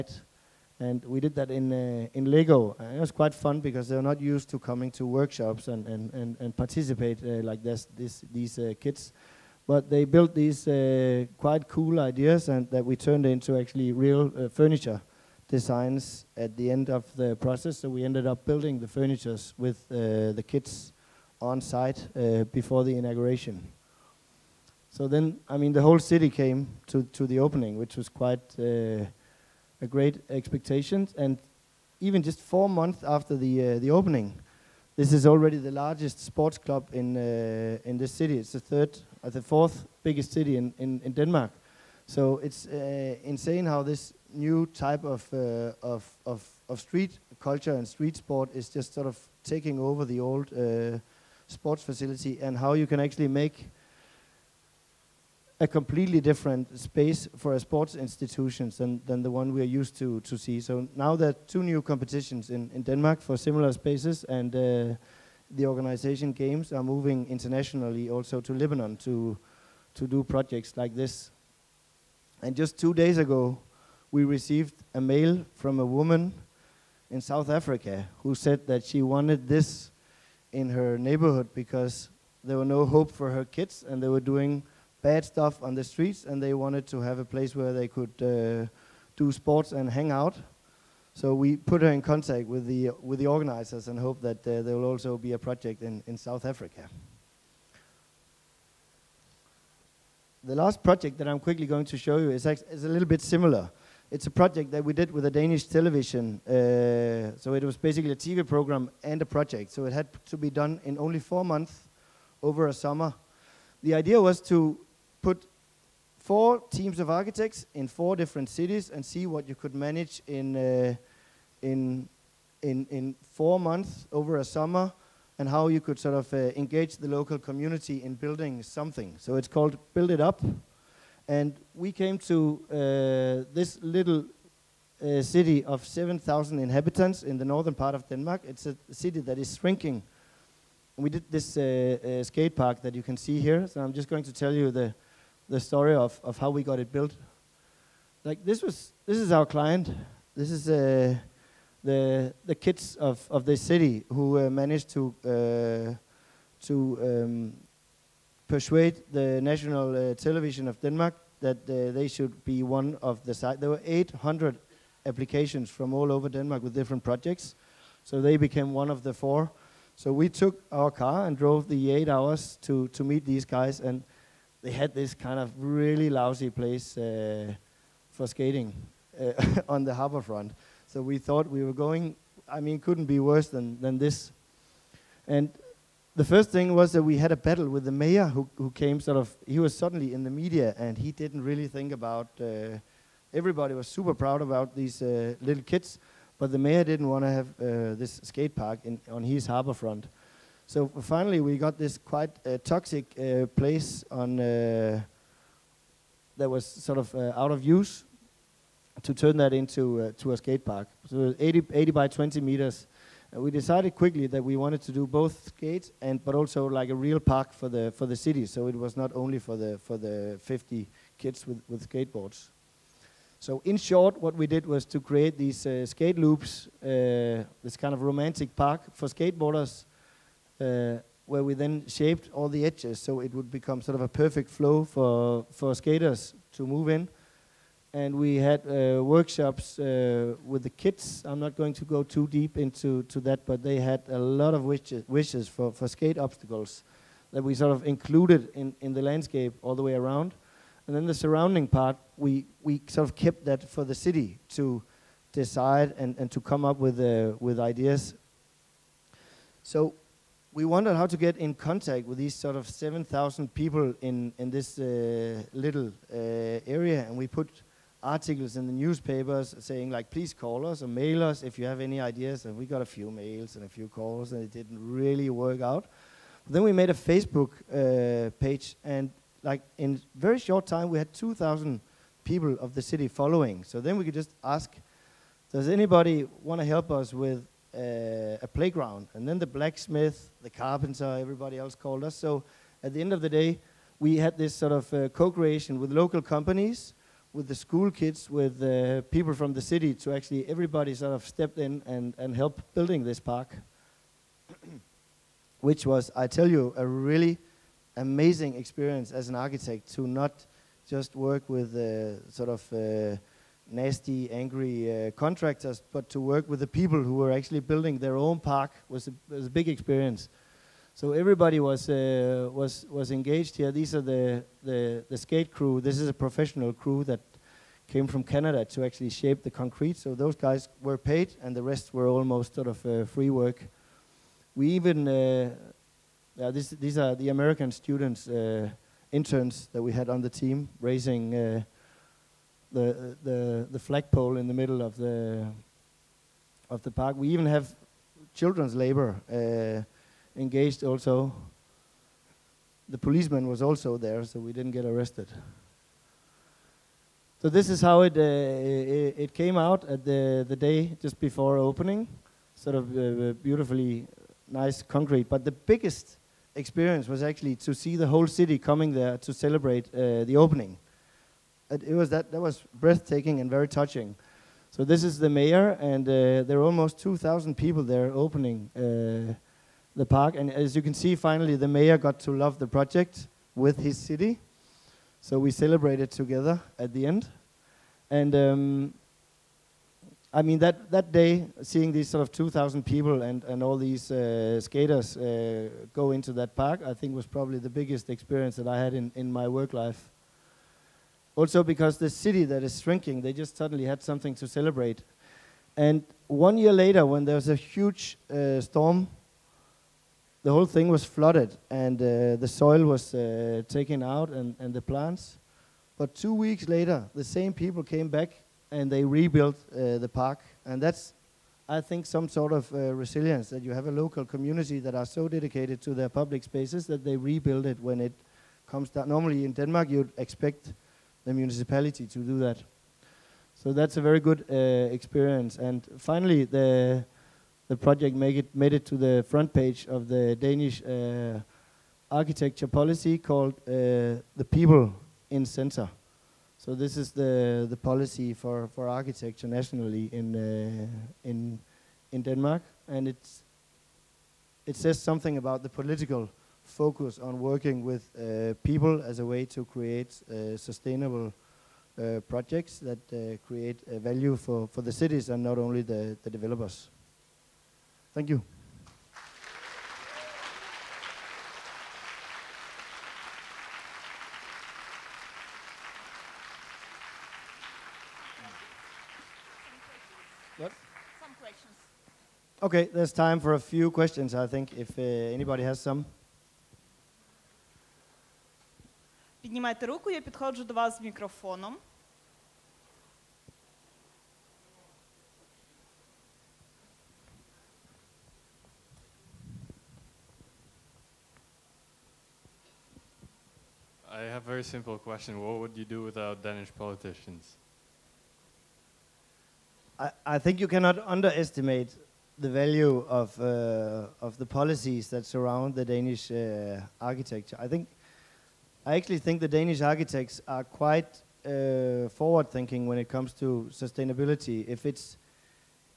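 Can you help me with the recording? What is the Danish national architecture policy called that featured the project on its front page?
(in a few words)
the people in center.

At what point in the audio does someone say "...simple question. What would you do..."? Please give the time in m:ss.
8:24.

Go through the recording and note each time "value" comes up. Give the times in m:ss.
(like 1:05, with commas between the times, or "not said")
7:44, 8:32.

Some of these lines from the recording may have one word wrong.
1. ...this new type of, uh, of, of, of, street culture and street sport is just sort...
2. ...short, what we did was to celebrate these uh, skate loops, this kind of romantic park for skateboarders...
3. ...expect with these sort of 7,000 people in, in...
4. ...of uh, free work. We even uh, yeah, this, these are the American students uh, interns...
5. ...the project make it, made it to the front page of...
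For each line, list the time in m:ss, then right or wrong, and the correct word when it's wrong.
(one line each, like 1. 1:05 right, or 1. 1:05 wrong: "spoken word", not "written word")
1. 0:43 right
2. 3:43 wrong: "create", not "celebrate"
3. 4:21 wrong: "contact", not "expect"
4. 5:32 right
5. 7:17 right.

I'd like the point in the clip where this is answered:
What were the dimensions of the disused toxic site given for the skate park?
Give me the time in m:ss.
3:31.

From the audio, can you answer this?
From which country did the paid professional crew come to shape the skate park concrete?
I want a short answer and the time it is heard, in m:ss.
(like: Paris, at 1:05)
Canada, at 5:28.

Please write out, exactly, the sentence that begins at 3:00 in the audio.
So we thought we were going, I mean, couldn't be worse than, than this.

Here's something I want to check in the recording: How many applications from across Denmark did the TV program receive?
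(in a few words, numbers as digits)
800.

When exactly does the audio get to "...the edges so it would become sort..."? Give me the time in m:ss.
3:52.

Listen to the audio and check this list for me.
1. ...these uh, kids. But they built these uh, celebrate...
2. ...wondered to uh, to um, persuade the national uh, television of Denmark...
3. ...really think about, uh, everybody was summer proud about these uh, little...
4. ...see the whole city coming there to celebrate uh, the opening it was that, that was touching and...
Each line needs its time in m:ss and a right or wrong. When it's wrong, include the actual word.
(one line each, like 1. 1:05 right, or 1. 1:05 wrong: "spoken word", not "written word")
1. 0:08 wrong: "quite", not "celebrate"
2. 2:34 wrong: "managed", not "wondered"
3. 3:11 wrong: "super", not "summer"
4. 6:07 wrong: "breathtaking", not "touching".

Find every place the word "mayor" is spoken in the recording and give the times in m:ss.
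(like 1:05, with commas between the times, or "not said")
3:07, 3:16, 6:15, 6:21.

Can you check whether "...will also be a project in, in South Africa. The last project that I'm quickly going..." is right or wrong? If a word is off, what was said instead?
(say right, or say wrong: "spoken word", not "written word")
right.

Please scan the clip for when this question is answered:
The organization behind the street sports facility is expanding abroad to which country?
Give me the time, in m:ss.
1:08.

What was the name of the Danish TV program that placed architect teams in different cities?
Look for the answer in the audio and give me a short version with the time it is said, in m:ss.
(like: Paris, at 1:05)
Build It Up, at 2:09.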